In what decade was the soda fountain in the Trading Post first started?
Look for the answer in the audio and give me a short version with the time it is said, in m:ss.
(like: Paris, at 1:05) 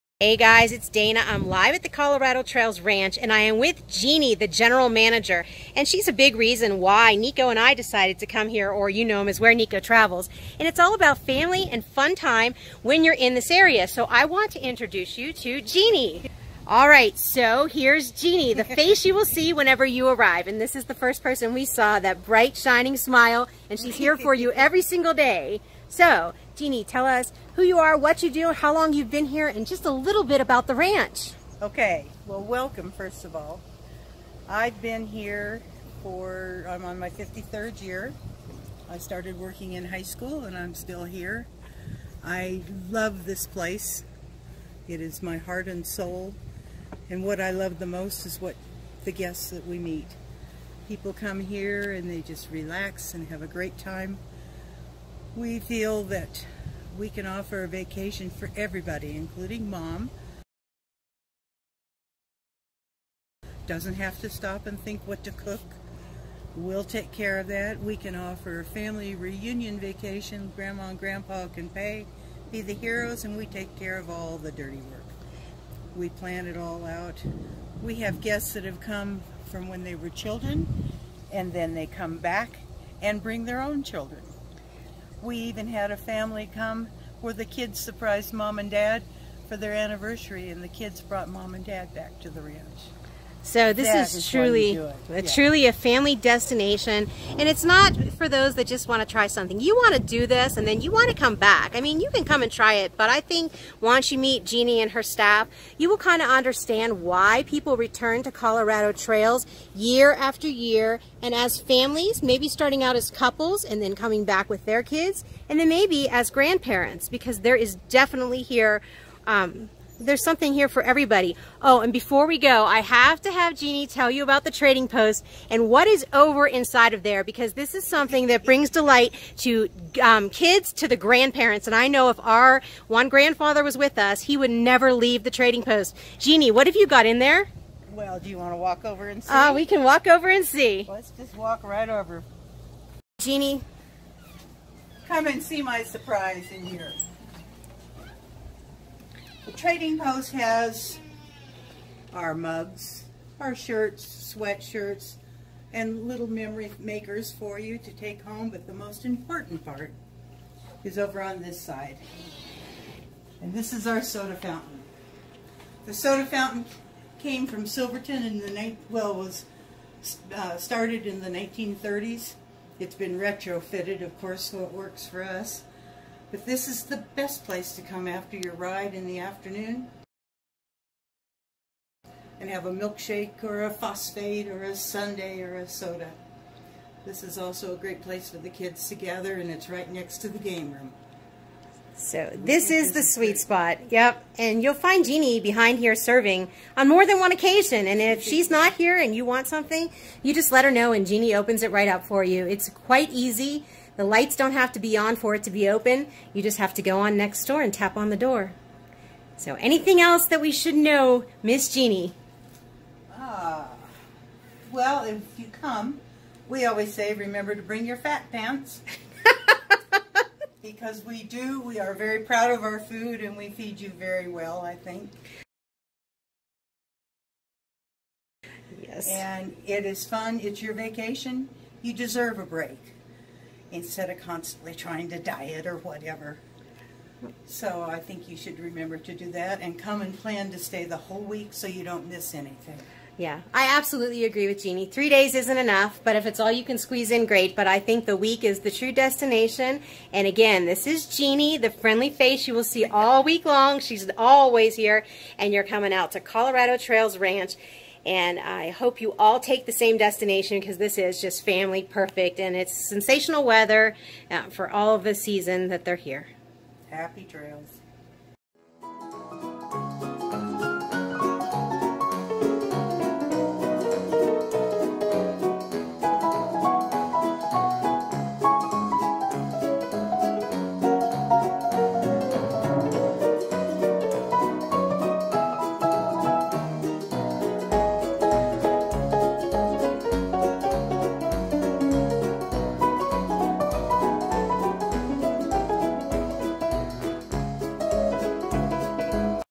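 1930s, at 2:51.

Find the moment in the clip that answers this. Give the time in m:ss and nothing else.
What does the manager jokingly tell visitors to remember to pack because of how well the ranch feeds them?
3:37.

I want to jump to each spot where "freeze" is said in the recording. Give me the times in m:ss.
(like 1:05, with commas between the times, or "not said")
not said.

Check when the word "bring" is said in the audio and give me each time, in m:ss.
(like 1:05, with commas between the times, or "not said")
1:23, 2:08, 3:37.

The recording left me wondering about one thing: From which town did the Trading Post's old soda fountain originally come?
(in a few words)
Silverton.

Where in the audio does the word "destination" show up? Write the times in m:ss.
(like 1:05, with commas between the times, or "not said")
1:36, 4:08, 4:19.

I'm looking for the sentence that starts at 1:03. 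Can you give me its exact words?
Doesn't have to stop and think what to cook.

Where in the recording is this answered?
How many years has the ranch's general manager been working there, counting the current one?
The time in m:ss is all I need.
0:37.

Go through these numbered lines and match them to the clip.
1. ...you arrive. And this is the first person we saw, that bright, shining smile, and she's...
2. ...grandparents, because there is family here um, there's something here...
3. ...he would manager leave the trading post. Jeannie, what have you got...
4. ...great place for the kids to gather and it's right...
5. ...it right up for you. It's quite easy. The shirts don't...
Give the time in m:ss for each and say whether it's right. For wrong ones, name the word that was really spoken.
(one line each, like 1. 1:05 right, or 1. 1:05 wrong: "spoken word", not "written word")
1. 0:19 right
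2. 1:56 wrong: "definitely", not "family"
3. 2:14 wrong: "never", not "manager"
4. 3:07 right
5. 3:21 wrong: "lights", not "shirts".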